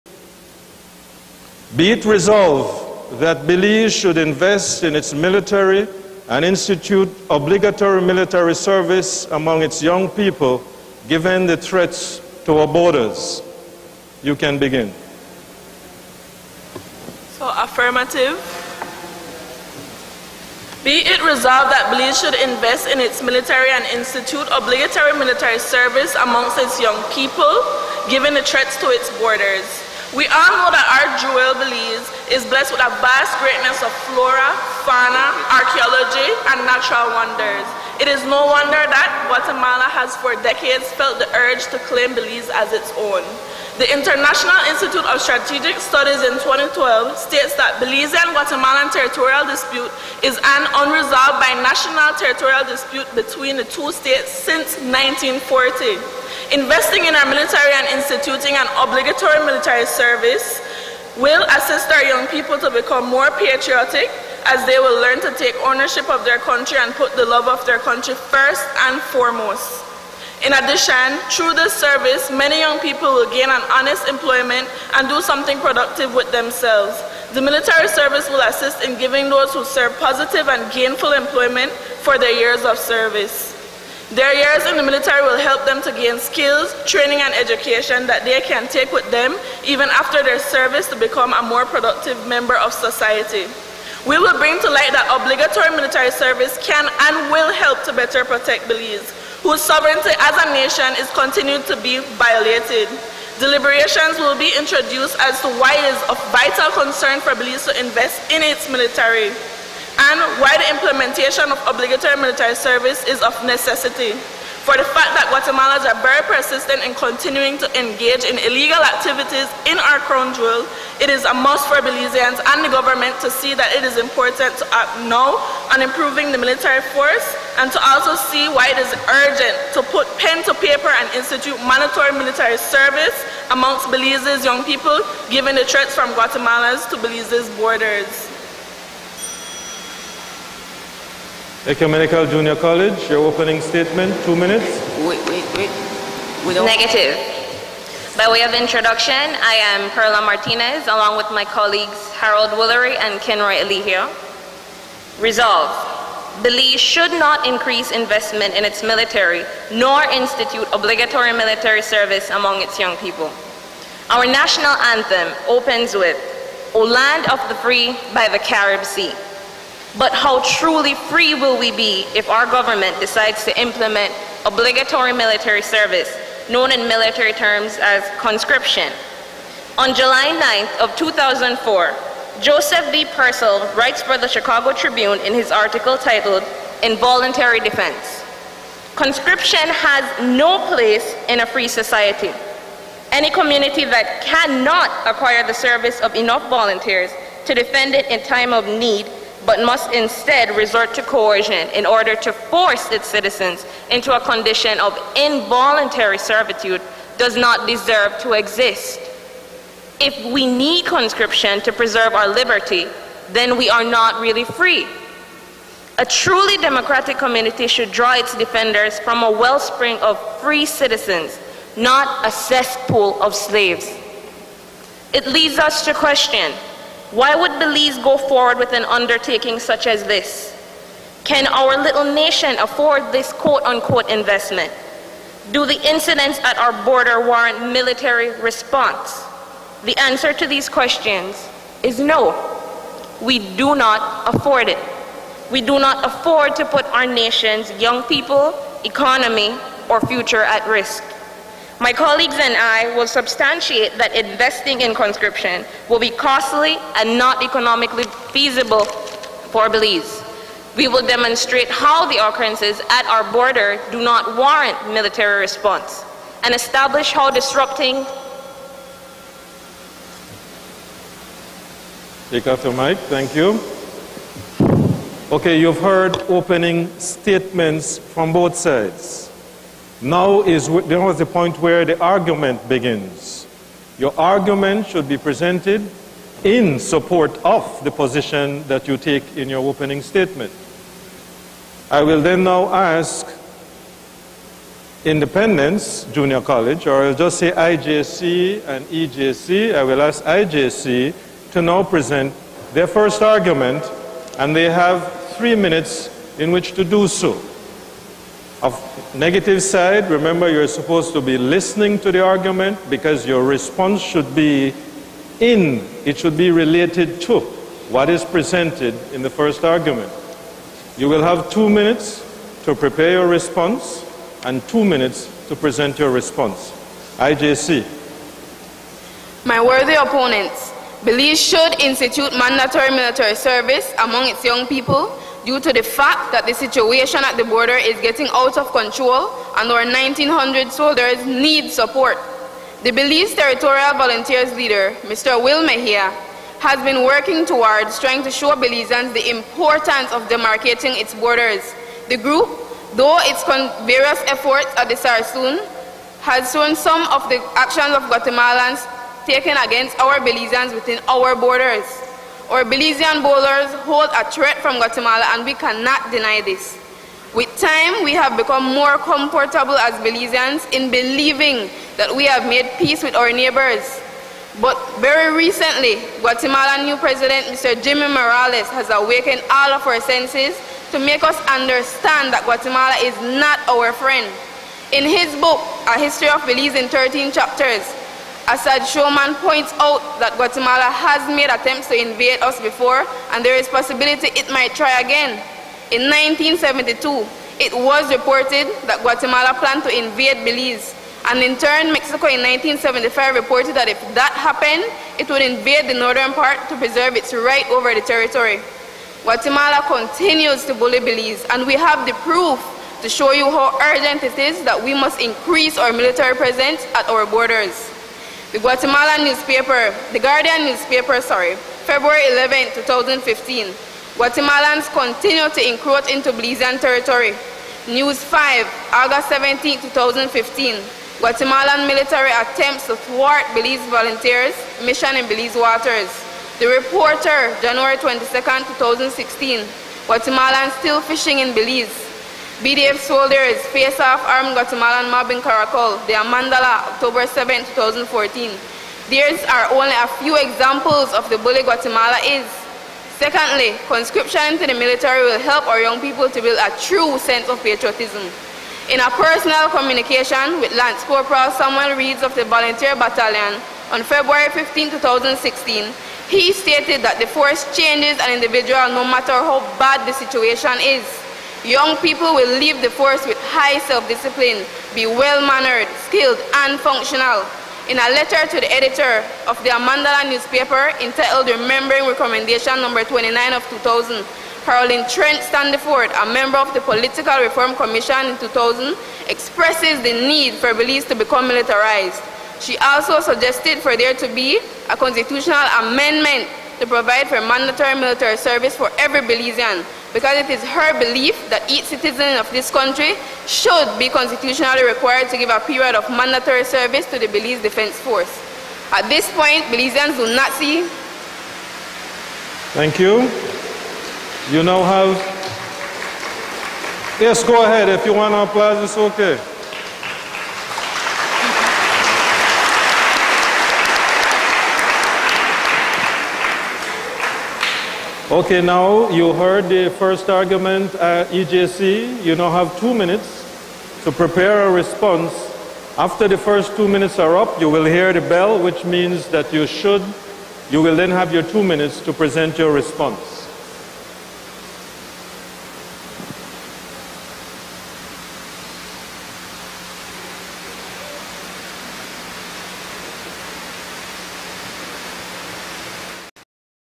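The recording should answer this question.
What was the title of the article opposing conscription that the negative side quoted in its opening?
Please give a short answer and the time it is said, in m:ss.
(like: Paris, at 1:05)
Involuntary Defense, at 3:06.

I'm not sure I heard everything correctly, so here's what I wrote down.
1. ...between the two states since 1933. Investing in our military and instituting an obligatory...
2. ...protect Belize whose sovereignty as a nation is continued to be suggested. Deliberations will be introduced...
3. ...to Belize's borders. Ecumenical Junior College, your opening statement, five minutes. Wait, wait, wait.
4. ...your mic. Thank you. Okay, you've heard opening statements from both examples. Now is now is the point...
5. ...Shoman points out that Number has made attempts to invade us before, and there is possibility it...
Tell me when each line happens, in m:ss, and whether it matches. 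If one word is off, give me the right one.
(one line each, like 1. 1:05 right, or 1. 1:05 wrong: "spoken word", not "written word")
1. 0:53 wrong: "1940", not "1933"
2. 1:38 wrong: "violated", not "suggested"
3. 2:16 wrong: "two", not "five"
4. 4:32 wrong: "sides", not "examples"
5. 6:28 wrong: "Guatemala", not "Number".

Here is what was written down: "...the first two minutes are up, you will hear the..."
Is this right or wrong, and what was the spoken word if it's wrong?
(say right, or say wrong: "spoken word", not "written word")
right.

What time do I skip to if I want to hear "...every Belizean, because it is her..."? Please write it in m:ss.
8:18.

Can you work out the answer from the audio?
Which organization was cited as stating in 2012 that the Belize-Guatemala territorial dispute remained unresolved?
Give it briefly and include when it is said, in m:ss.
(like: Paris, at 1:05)
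International Institute of Strategic Studies, at 0:43.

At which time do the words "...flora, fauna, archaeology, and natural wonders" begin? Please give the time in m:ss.
0:34.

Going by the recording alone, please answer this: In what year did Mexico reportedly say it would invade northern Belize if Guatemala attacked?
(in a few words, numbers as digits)
1975.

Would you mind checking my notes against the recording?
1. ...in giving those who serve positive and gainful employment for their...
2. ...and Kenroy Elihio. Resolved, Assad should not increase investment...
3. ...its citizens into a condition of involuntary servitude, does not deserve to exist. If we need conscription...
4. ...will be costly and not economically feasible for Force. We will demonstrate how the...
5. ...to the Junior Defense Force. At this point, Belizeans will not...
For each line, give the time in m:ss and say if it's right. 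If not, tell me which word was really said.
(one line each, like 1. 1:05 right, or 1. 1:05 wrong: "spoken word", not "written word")
1. 1:18 right
2. 2:32 wrong: "Belize", not "Assad"
3. 3:22 right
4. 4:15 wrong: "Belize", not "Force"
5. 8:27 wrong: "Belize", not "Junior".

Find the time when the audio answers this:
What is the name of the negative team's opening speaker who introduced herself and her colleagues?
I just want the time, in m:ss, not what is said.
2:29.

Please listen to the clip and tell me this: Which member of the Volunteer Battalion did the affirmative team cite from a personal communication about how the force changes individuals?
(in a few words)
Samuel Reeds.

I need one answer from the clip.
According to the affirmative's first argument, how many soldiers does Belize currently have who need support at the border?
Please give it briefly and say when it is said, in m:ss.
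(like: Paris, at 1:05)
1,900, at 5:39.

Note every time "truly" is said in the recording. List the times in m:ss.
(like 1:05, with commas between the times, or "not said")
2:50, 3:36.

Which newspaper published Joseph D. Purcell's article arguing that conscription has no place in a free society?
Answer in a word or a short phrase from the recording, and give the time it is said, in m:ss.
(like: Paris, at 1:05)
Chicago Tribune, at 3:04.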